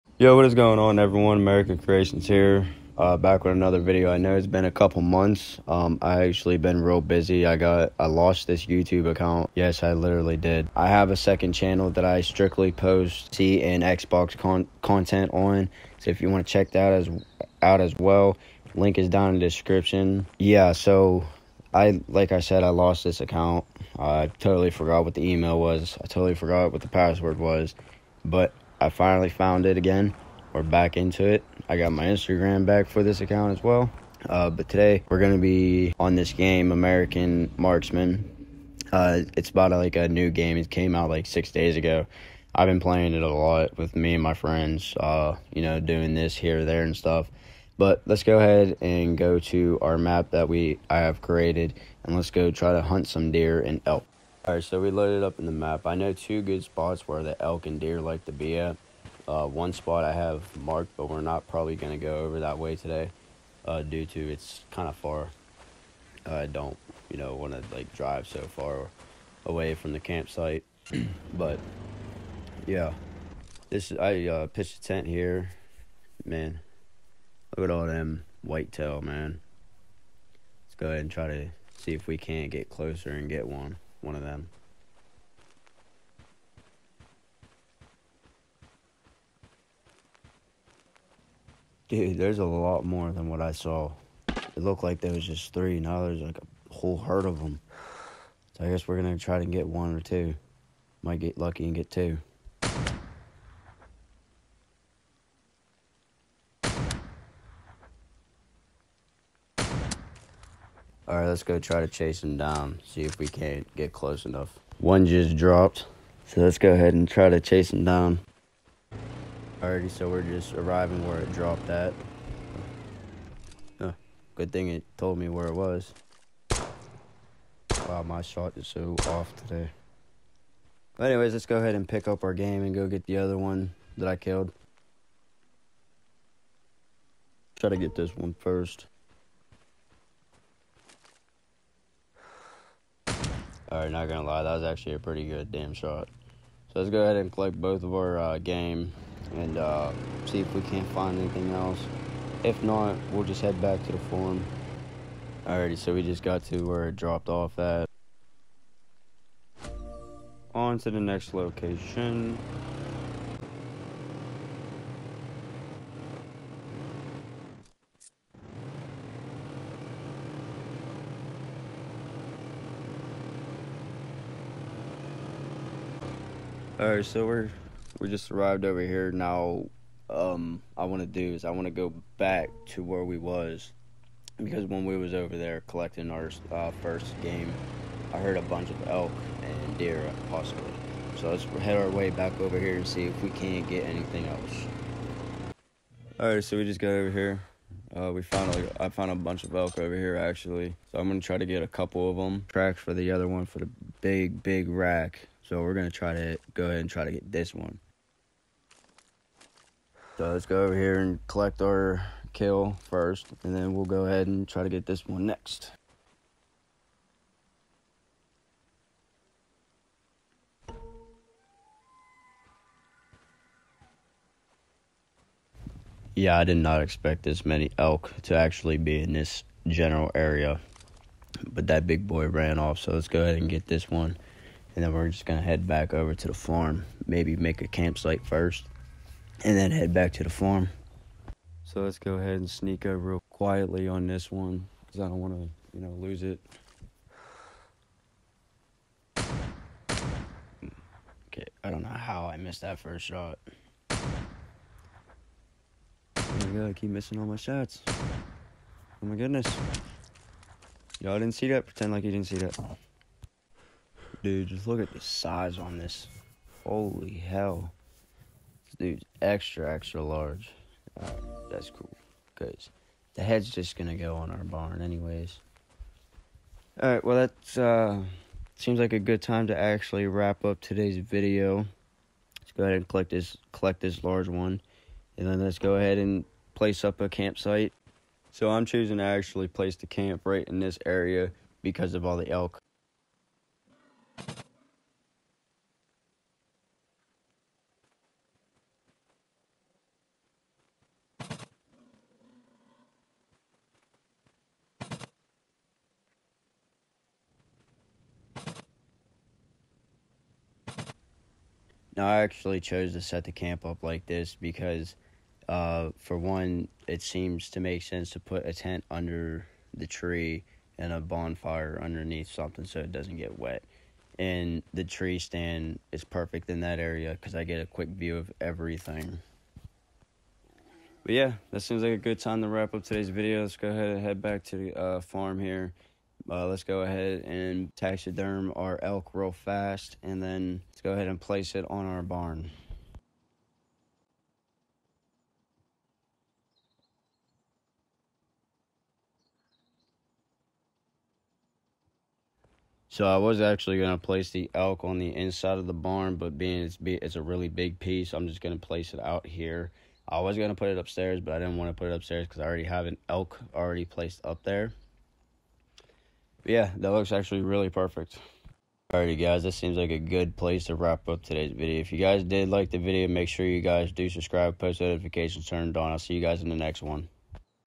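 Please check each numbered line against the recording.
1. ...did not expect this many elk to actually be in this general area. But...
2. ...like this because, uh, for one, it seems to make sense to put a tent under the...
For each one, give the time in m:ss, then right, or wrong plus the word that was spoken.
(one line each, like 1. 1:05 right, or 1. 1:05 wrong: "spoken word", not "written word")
1. 3:46 right
2. 5:13 right.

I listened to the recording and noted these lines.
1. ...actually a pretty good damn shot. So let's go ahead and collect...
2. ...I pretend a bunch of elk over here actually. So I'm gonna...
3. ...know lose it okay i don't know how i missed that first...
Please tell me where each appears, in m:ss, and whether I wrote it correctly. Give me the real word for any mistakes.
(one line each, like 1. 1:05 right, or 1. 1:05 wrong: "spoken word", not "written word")
1. 2:24 right
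2. 3:18 wrong: "found", not "pretend"
3. 4:05 right.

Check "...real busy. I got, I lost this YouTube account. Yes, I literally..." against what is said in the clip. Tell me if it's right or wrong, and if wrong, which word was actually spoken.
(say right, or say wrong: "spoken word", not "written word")
right.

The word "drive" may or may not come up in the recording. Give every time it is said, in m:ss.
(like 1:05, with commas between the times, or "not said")
1:07.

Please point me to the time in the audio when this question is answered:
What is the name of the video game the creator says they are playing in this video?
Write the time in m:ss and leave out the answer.
0:36.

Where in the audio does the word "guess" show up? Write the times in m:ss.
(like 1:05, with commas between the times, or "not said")
1:38.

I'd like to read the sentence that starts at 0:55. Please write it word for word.
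I know two good spots where the elk and deer like to be at.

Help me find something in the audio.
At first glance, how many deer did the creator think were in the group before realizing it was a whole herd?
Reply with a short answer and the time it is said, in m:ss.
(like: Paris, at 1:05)
3, at 1:35.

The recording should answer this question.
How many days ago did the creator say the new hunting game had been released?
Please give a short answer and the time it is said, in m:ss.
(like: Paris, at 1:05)
6, at 0:41.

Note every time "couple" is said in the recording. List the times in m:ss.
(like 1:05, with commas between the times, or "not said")
0:04, 3:21.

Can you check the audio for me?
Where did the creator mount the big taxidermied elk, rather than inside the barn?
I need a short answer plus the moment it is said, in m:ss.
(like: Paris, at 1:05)
out here, at 5:58.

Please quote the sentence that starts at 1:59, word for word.
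Alrighty, so we're just arriving where it dropped at.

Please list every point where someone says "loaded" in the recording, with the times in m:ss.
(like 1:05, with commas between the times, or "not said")
0:54.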